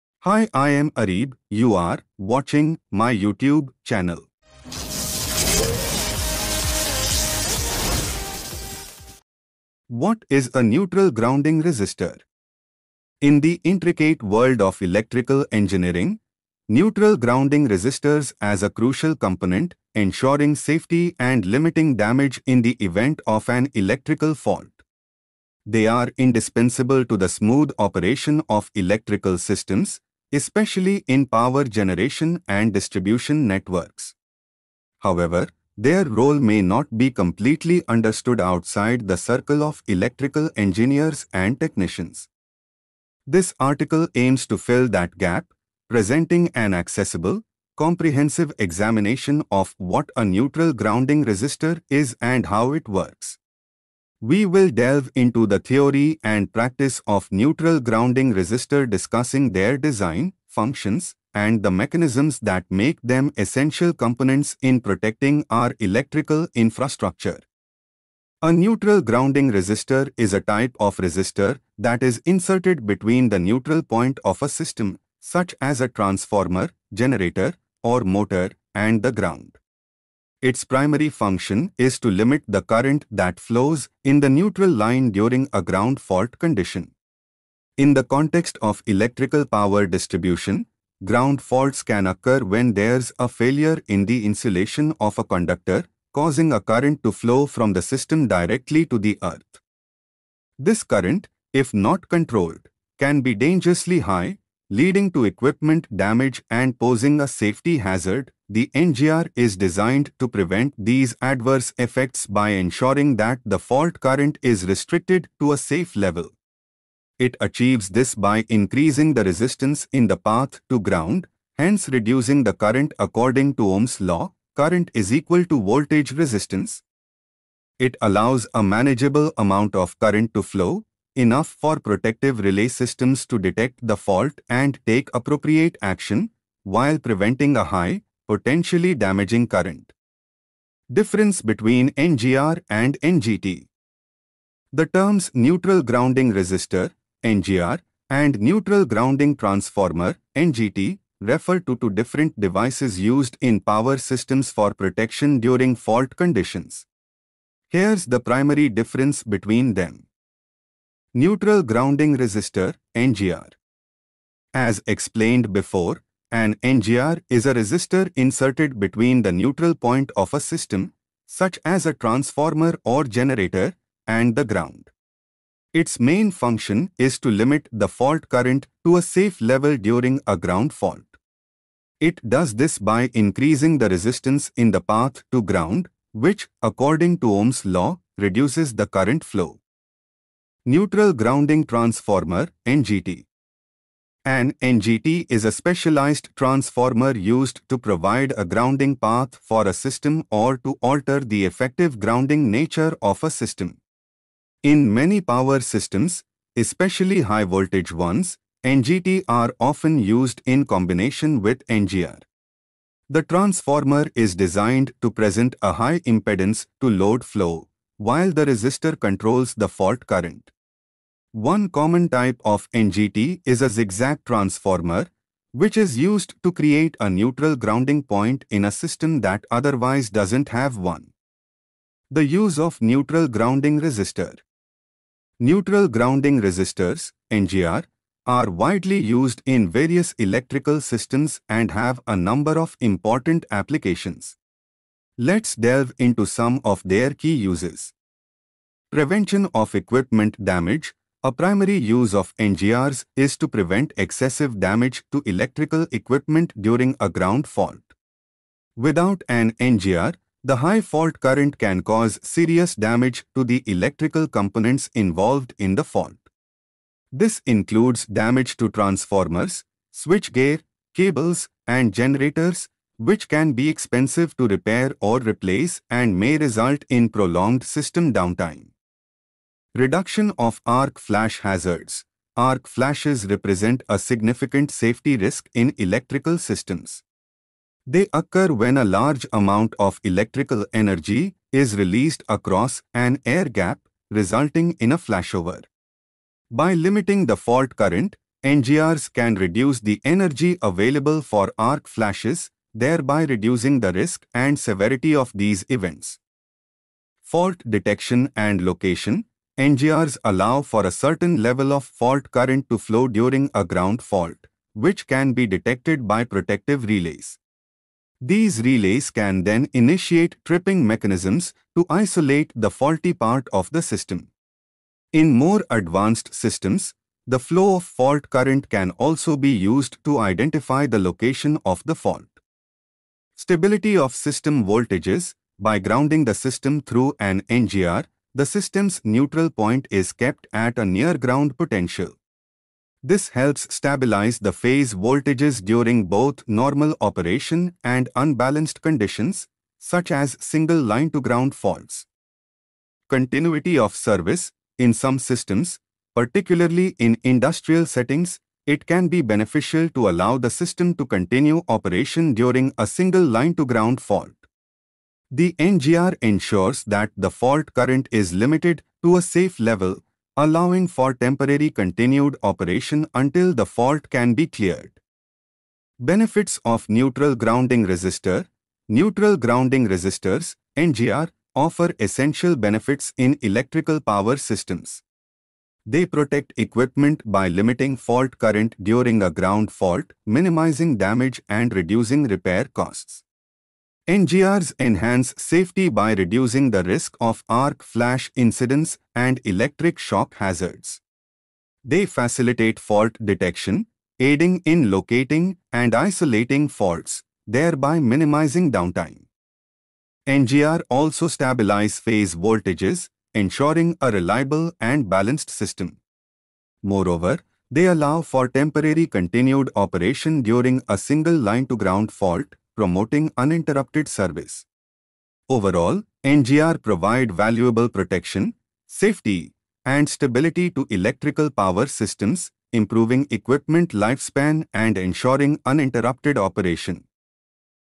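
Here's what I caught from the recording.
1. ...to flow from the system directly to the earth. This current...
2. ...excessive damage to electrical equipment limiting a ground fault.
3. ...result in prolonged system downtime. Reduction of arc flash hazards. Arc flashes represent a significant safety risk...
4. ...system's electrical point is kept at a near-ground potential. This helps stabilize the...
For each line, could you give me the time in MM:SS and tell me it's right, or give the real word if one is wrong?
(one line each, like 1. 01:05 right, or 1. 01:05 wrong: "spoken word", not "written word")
1. 01:37 right
2. 04:13 wrong: "during", not "limiting"
3. 04:36 right
4. 05:38 wrong: "neutral", not "electrical".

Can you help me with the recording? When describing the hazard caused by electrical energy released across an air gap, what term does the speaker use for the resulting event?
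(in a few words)
flashover.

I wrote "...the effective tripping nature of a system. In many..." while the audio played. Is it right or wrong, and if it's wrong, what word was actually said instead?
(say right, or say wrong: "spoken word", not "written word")
wrong: "grounding", not "tripping".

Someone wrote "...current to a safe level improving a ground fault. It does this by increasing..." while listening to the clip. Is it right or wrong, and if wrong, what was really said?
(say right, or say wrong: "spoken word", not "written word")
wrong: "during", not "improving".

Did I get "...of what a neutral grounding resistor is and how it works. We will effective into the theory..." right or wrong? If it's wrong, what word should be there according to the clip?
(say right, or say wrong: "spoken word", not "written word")
wrong: "delve", not "effective".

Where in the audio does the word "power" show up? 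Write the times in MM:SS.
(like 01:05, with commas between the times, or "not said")
00:31, 01:29, 02:33, 03:25, 06:24, 07:11.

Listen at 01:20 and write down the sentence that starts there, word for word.
Its primary function is to limit the current that flows in the neutral line during a ground fault condition.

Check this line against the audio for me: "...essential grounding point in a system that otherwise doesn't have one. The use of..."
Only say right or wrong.
wrong.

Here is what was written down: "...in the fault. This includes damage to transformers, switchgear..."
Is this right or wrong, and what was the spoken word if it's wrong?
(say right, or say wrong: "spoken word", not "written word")
right.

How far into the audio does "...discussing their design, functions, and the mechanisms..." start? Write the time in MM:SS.
00:58.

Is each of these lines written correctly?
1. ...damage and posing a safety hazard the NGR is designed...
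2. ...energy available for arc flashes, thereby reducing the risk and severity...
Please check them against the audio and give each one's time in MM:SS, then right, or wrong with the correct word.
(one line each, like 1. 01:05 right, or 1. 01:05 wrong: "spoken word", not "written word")
1. 01:45 right
2. 05:00 right.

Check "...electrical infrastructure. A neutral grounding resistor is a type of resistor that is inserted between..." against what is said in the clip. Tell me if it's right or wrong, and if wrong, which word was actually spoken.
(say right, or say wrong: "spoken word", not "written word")
right.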